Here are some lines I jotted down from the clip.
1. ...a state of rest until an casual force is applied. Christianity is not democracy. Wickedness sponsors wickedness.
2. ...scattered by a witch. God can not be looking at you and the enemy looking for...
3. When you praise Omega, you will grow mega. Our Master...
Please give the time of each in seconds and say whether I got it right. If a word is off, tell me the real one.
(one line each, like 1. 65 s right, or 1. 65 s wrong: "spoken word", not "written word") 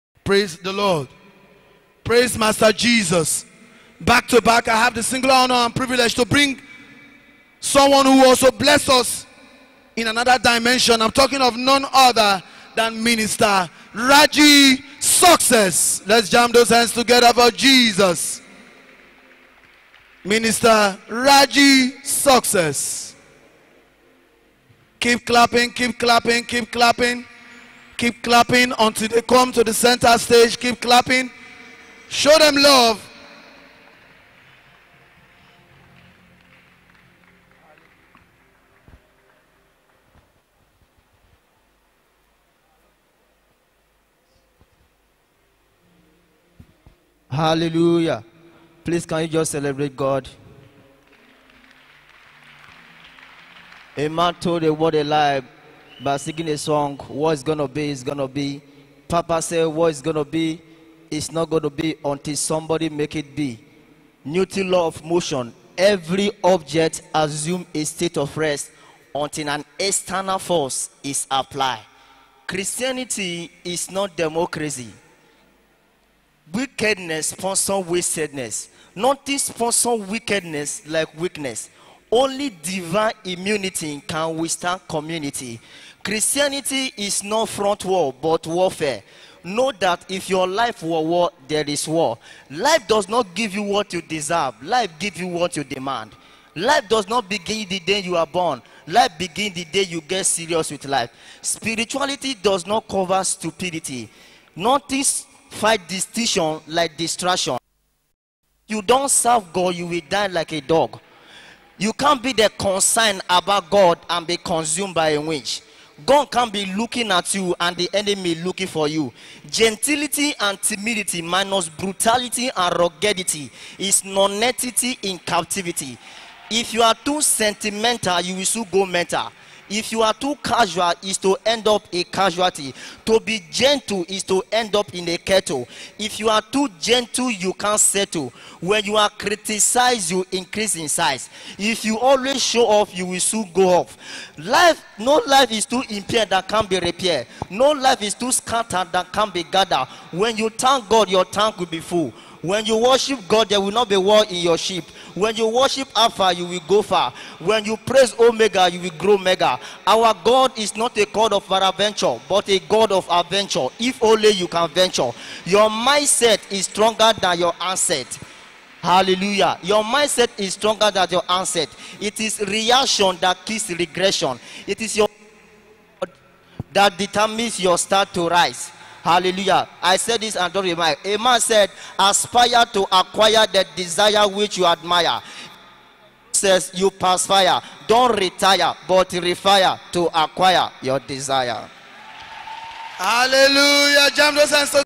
1. 67 s wrong: "external", not "casual"
2. 114 s wrong: "consumed", not "scattered"
3. 157 s wrong: "God", not "Master".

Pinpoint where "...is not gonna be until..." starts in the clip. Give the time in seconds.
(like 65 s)
61 s.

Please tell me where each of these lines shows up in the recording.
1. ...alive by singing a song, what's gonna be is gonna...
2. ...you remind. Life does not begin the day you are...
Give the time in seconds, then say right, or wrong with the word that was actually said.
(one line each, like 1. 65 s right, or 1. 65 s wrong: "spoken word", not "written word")
1. 54 s right
2. 95 s wrong: "demand", not "remind".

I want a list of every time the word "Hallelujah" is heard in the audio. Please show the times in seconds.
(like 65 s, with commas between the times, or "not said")
47 s, 168 s, 179 s, 192 s.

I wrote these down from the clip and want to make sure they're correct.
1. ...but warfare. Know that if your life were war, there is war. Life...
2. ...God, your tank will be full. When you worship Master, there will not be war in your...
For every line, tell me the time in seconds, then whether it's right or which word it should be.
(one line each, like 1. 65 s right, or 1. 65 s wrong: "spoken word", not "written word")
1. 88 s right
2. 150 s wrong: "God", not "Master".